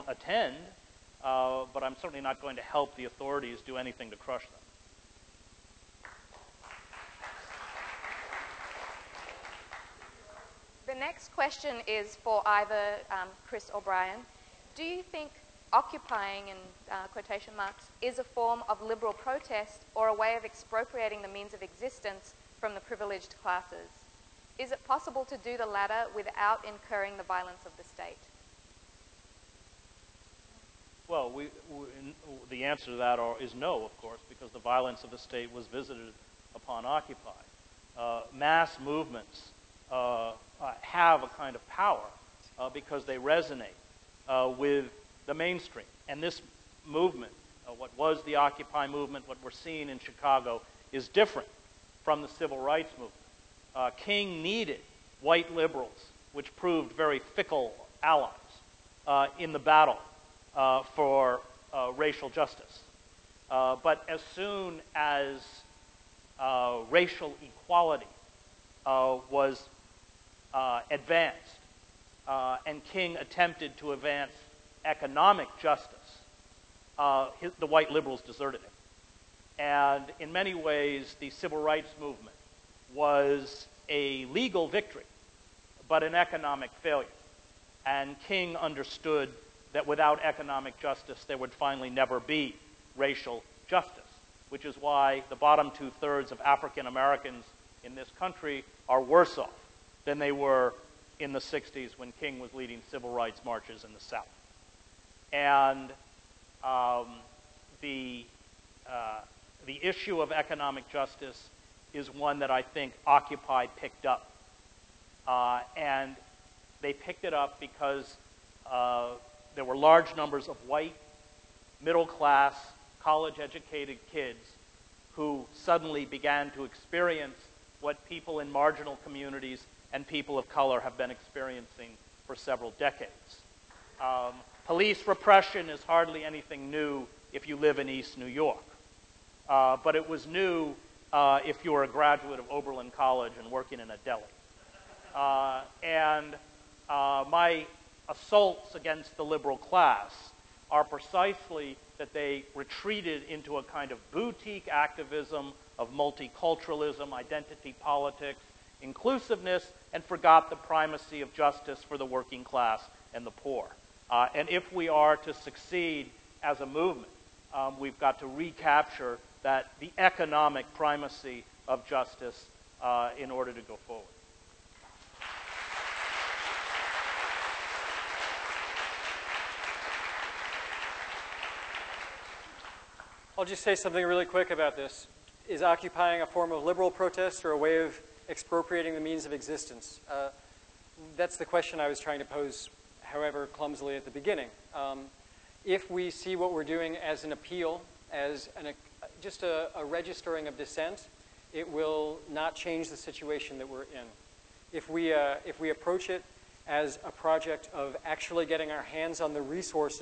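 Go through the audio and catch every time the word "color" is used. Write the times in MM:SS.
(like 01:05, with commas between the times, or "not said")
02:10.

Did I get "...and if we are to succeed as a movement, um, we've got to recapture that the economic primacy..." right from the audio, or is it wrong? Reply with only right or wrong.
right.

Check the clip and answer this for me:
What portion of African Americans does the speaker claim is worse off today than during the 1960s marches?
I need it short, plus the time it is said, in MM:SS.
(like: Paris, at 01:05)
Bottom two thirds, at 01:35.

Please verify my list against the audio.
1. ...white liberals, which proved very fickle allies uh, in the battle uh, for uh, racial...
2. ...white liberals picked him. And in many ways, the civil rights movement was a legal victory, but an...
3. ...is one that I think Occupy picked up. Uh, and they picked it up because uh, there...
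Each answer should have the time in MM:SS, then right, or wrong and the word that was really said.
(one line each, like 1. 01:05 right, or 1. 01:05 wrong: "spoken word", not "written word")
1. 00:55 right
2. 01:17 wrong: "deserted", not "picked"
3. 01:51 right.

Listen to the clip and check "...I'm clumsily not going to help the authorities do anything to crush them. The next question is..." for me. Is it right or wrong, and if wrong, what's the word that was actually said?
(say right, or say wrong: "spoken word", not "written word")
wrong: "certainly", not "clumsily".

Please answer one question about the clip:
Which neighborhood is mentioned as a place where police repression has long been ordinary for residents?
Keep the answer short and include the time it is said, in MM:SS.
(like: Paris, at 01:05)
East New York, at 02:17.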